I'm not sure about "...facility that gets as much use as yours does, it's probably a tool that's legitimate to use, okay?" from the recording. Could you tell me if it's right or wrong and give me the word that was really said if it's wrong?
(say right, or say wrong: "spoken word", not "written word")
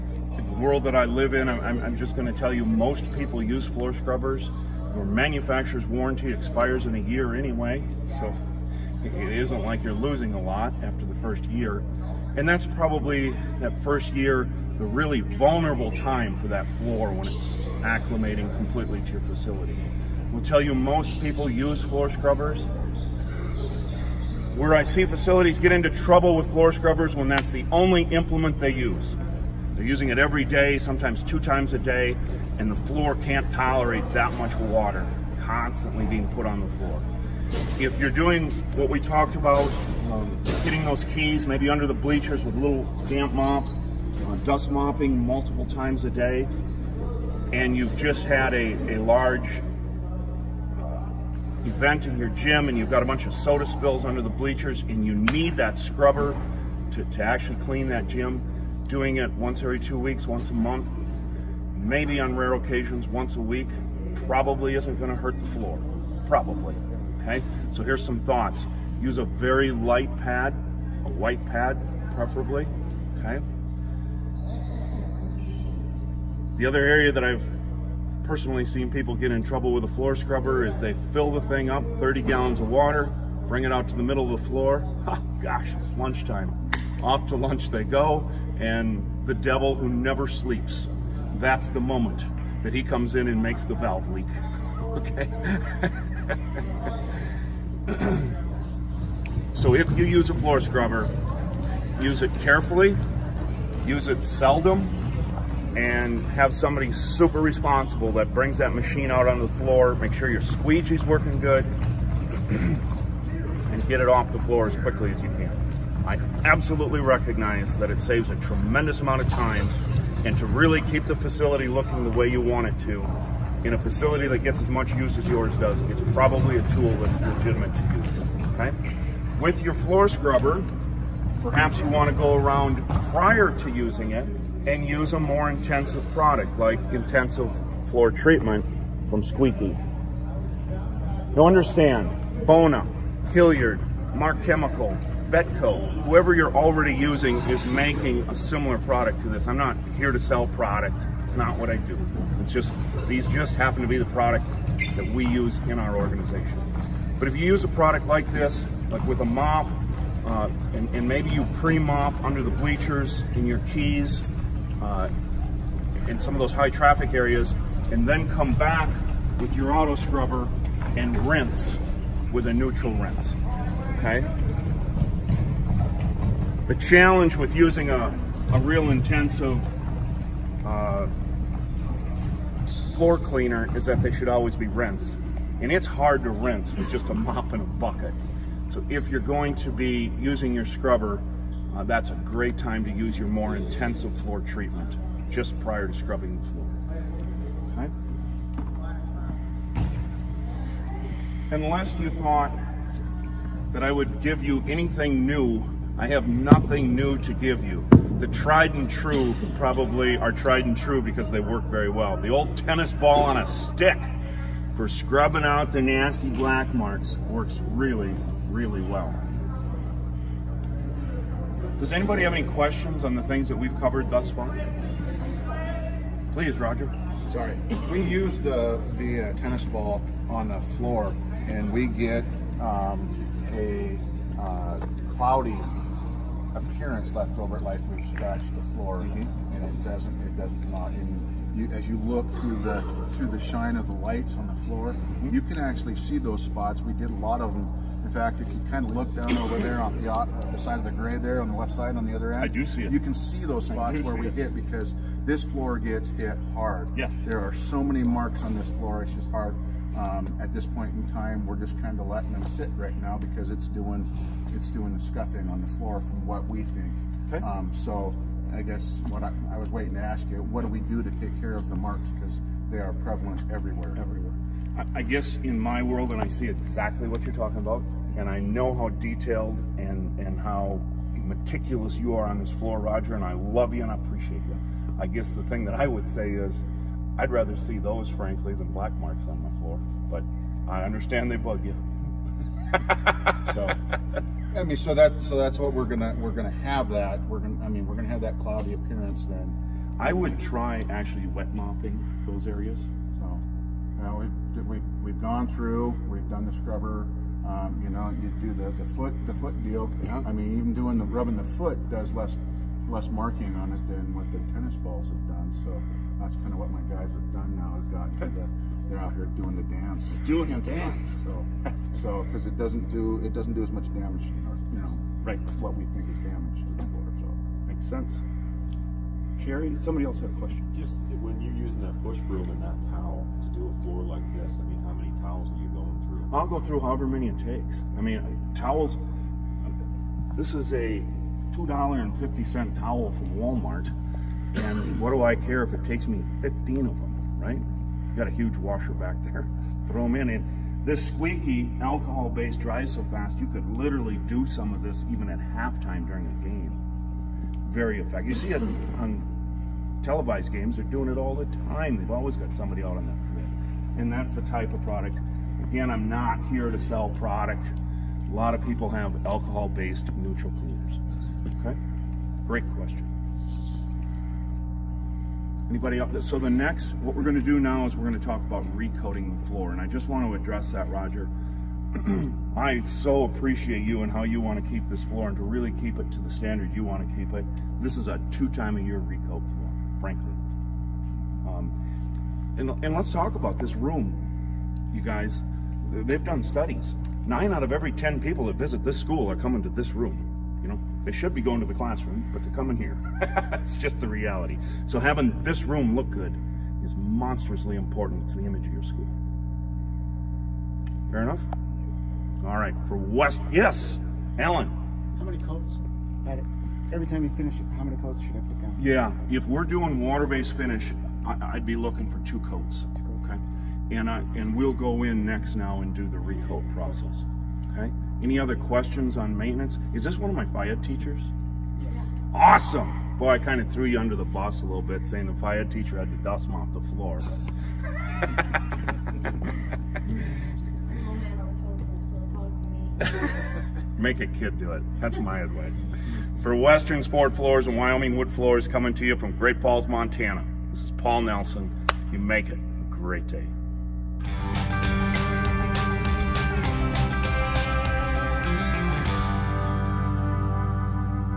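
right.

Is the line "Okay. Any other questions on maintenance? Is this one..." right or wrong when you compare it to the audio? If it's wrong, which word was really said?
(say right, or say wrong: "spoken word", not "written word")
right.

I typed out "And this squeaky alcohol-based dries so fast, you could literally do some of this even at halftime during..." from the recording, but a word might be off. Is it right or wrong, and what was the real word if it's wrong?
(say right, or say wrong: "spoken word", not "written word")
right.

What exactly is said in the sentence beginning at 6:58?
Yeah, if we're doing water-based finish, I, would be looking for two coats.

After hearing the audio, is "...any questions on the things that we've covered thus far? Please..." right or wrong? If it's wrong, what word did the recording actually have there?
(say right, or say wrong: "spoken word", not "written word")
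right.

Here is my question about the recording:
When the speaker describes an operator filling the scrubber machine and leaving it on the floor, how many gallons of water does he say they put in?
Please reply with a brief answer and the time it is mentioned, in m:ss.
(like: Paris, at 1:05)
30, at 1:21.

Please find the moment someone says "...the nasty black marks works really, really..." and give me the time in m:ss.
3:35.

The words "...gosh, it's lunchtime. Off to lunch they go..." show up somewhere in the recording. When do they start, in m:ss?
1:25.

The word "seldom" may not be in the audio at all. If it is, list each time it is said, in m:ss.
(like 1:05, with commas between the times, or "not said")
1:44.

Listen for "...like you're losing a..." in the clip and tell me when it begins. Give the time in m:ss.
0:09.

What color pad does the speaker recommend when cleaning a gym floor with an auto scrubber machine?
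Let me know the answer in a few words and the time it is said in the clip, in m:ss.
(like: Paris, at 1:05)
White, at 1:11.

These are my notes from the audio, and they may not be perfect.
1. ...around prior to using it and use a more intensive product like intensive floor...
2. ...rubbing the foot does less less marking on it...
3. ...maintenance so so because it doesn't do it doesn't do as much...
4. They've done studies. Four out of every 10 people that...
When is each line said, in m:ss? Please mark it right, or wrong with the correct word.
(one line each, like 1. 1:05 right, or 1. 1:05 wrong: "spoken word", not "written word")
1. 2:12 right
2. 5:11 right
3. 5:20 wrong: "dance", not "maintenance"
4. 6:35 wrong: "Nine", not "Four".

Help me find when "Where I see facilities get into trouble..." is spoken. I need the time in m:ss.
0:24.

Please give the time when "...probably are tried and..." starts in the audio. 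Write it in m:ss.
3:29.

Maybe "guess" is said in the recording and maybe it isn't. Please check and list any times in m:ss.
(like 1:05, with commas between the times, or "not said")
4:28, 4:35, 4:45.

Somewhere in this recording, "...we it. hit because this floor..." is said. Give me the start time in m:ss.
4:14.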